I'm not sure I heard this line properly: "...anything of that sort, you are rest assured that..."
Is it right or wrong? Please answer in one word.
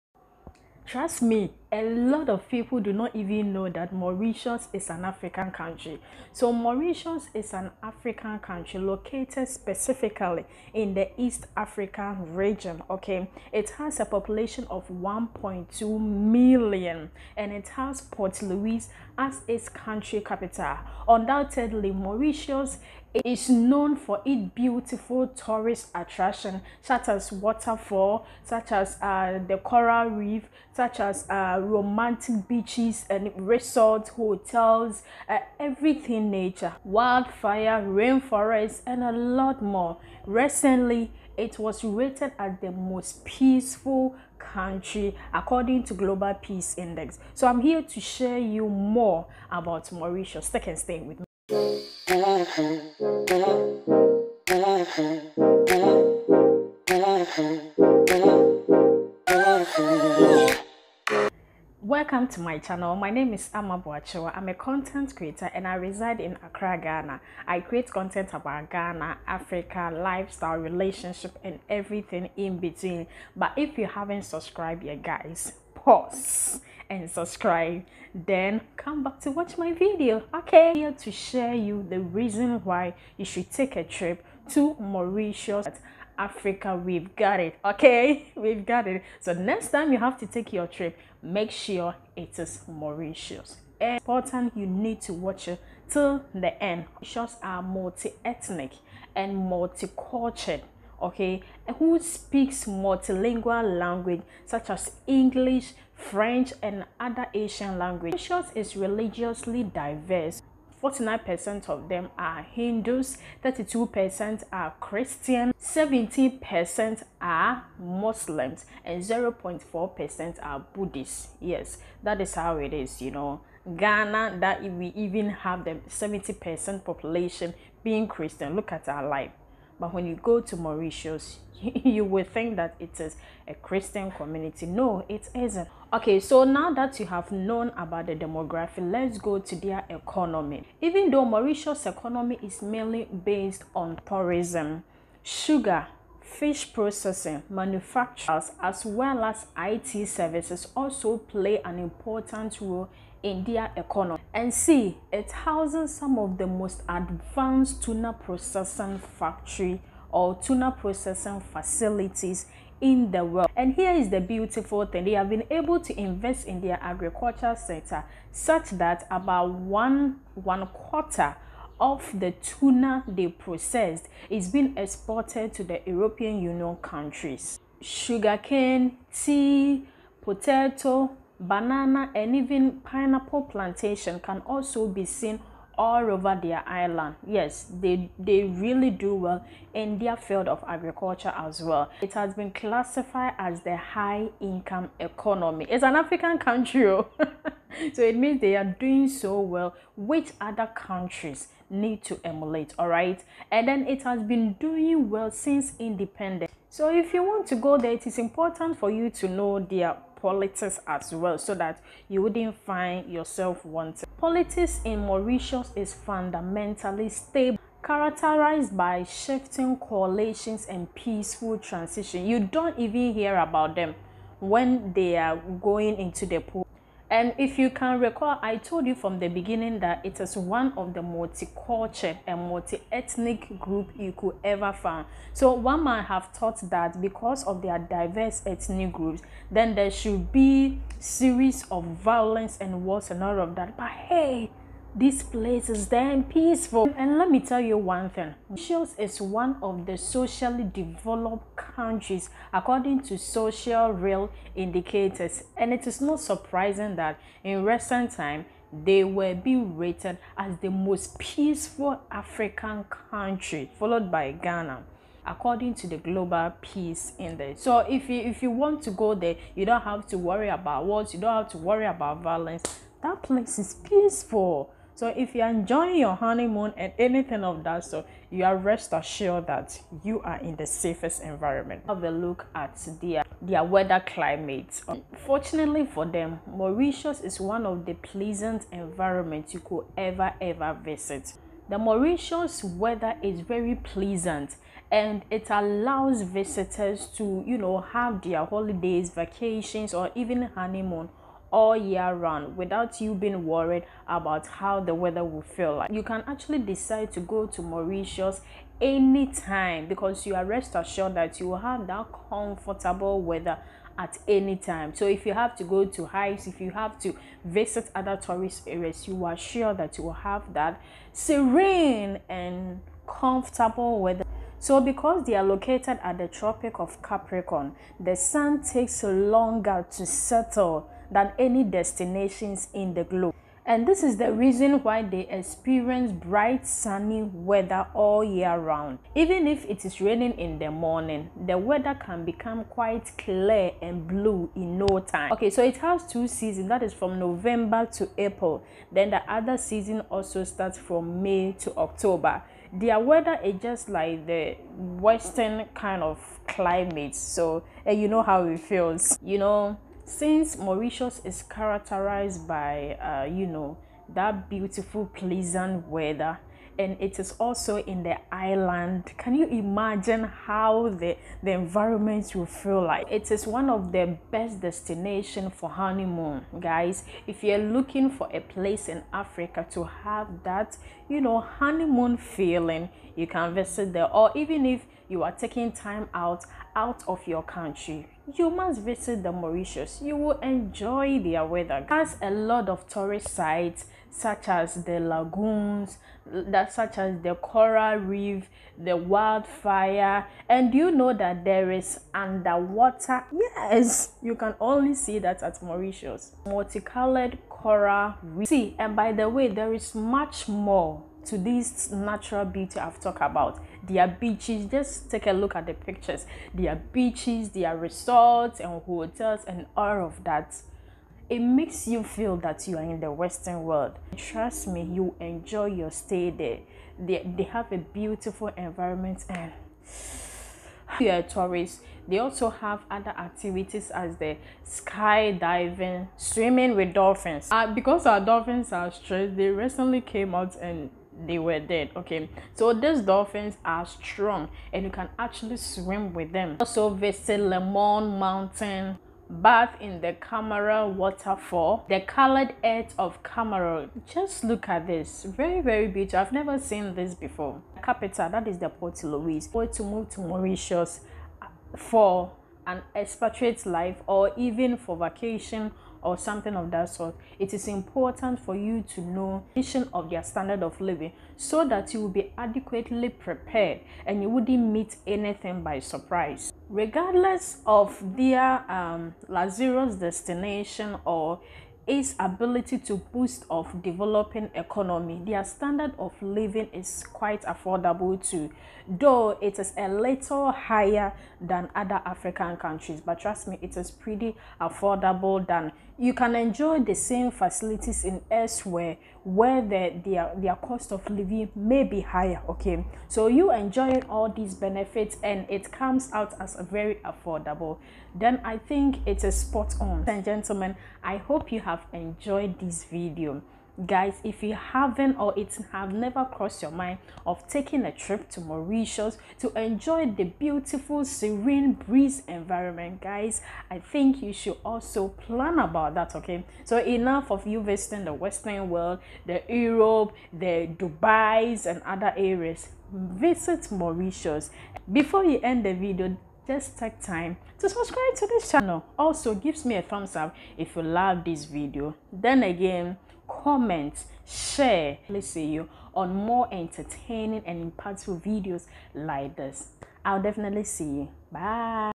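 right.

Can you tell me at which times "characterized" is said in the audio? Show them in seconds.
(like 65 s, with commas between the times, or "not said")
217 s, 361 s.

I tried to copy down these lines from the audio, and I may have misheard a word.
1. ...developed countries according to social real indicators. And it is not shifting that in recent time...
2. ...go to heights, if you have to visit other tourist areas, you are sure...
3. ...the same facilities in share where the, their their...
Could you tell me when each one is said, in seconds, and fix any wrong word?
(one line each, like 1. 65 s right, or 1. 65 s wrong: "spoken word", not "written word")
1. 250 s wrong: "surprising", not "shifting"
2. 315 s right
3. 496 s wrong: "elsewhere", not "share".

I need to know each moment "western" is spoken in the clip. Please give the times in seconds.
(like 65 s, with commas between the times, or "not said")
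354 s, 423 s, 528 s.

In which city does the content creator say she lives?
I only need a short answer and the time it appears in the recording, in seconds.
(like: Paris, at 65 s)
Accra, at 66 s.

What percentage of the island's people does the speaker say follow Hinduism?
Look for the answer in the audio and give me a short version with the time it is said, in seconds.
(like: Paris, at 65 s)
49 percent, at 110 s.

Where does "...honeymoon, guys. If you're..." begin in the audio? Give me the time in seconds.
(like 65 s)
375 s.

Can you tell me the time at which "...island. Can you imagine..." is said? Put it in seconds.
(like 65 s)
368 s.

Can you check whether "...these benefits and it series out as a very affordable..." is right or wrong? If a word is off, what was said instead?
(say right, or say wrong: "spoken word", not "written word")
wrong: "comes", not "series".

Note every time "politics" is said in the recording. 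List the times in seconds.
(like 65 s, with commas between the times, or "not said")
210 s, 214 s.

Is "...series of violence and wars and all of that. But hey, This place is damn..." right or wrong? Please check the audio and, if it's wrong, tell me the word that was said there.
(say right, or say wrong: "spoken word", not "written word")
right.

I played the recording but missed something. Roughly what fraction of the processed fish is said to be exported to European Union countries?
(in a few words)
One quarter.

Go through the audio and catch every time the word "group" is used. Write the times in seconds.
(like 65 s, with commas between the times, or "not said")
233 s, 238 s.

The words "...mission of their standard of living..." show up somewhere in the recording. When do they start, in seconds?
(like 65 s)
469 s.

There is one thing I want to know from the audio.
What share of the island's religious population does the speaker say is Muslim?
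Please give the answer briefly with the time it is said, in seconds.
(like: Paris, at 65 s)
17 percent, at 115 s.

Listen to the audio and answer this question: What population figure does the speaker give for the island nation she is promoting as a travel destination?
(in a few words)
1.2 million.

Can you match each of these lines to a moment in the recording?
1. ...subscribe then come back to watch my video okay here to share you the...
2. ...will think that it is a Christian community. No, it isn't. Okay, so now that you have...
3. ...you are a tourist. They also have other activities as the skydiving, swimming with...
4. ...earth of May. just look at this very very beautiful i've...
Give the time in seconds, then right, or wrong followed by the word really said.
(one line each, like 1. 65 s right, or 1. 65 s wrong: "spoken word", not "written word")
1. 77 s right
2. 132 s right
3. 430 s right
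4. 452 s wrong: "Chamarel", not "May".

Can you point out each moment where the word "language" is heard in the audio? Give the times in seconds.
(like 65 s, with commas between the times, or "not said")
103 s, 107 s.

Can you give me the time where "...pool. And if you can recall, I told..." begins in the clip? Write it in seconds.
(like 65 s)
226 s.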